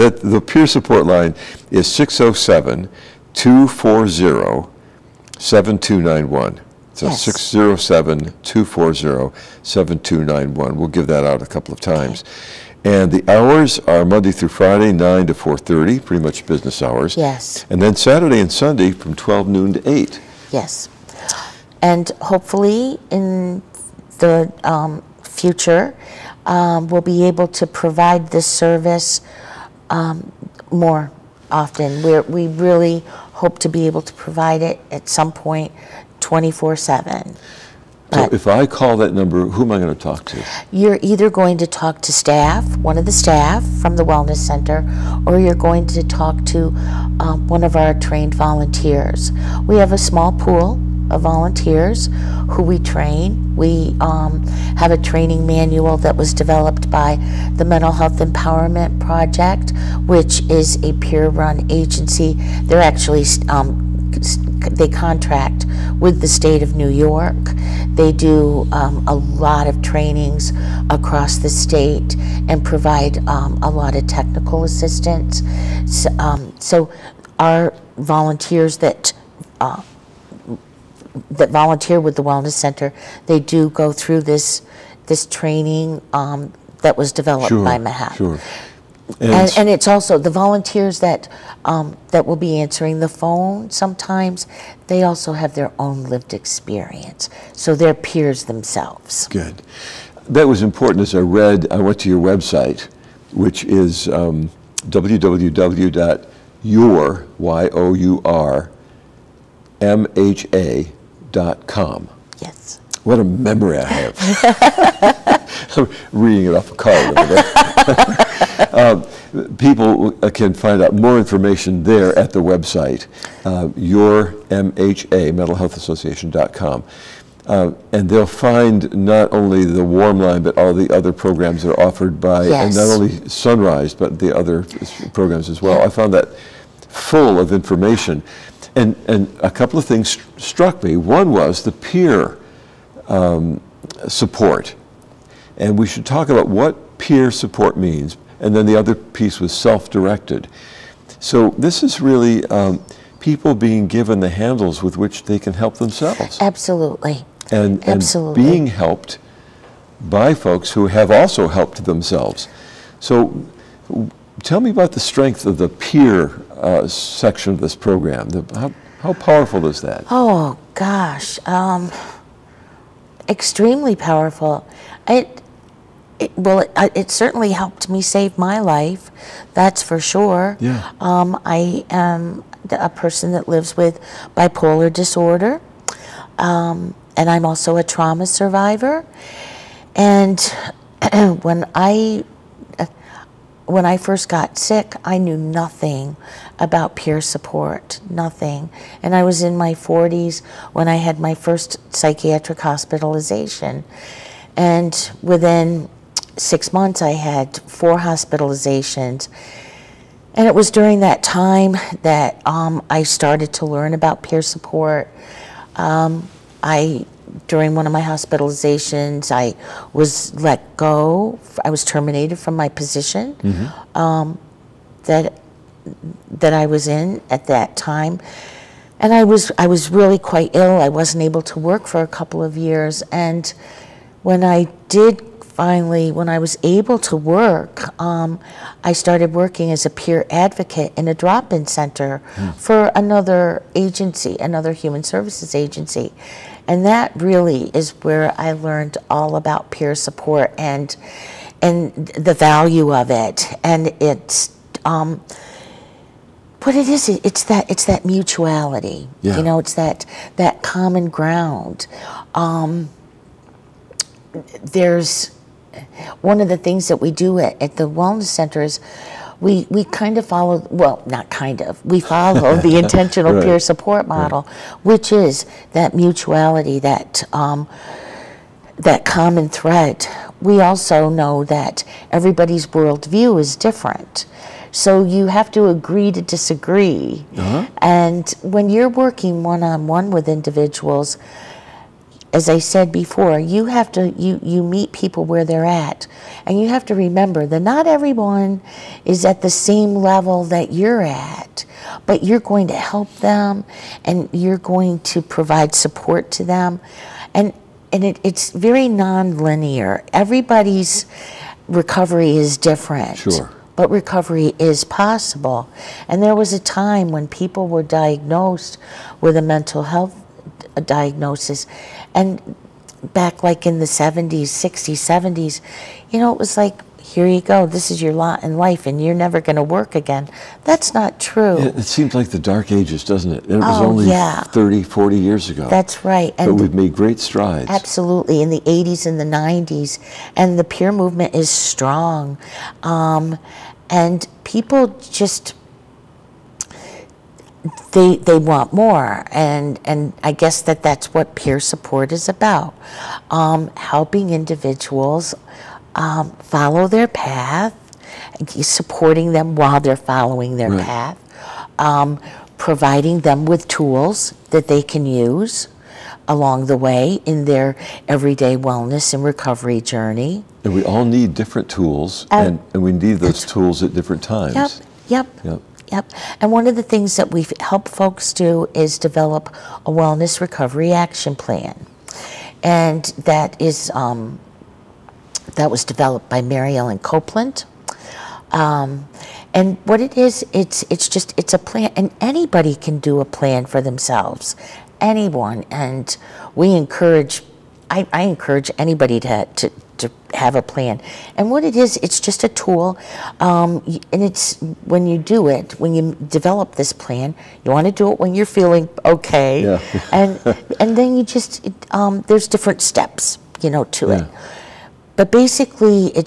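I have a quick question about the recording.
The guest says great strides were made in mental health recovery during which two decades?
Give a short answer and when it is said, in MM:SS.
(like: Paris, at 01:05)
the 80s and 90s, at 05:38.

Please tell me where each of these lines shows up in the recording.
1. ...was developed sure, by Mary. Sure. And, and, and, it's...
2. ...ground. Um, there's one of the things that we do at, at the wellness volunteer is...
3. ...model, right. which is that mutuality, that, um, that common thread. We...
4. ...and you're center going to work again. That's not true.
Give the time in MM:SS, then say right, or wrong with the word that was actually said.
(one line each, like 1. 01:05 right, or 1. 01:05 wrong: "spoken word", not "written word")
1. 01:26 wrong: "Mahat", not "Mary"
2. 04:21 wrong: "center", not "volunteer"
3. 04:34 right
4. 05:28 wrong: "never", not "center".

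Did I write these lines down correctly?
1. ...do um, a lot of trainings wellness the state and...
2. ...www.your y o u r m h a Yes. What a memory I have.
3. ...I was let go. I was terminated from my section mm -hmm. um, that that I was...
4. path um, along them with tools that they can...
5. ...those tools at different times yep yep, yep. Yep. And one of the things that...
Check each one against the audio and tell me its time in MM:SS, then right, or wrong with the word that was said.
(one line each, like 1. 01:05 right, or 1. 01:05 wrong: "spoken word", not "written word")
1. 01:08 wrong: "across", not "wellness"
2. 01:44 right
3. 03:39 wrong: "position", not "section"
4. 06:00 wrong: "providing", not "along"
5. 06:13 right.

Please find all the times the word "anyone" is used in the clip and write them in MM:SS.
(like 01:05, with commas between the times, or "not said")
06:34.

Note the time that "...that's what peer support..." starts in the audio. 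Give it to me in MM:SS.
05:50.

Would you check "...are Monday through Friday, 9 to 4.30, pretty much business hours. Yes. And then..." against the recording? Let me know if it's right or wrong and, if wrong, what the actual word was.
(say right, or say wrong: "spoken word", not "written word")
right.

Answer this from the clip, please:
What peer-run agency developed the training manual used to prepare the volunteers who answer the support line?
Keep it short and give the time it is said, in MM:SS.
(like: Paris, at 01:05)
Mental Health Empowerment Project, at 00:57.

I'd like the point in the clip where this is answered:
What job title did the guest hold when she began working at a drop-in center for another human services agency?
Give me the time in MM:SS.
03:59.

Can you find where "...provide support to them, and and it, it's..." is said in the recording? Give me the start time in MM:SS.
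05:05.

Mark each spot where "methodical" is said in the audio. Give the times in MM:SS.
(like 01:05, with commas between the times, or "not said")
not said.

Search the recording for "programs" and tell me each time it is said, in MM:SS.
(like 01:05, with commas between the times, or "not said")
02:11, 02:15, 02:47.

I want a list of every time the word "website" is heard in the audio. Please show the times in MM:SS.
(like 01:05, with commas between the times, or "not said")
01:42, 02:02.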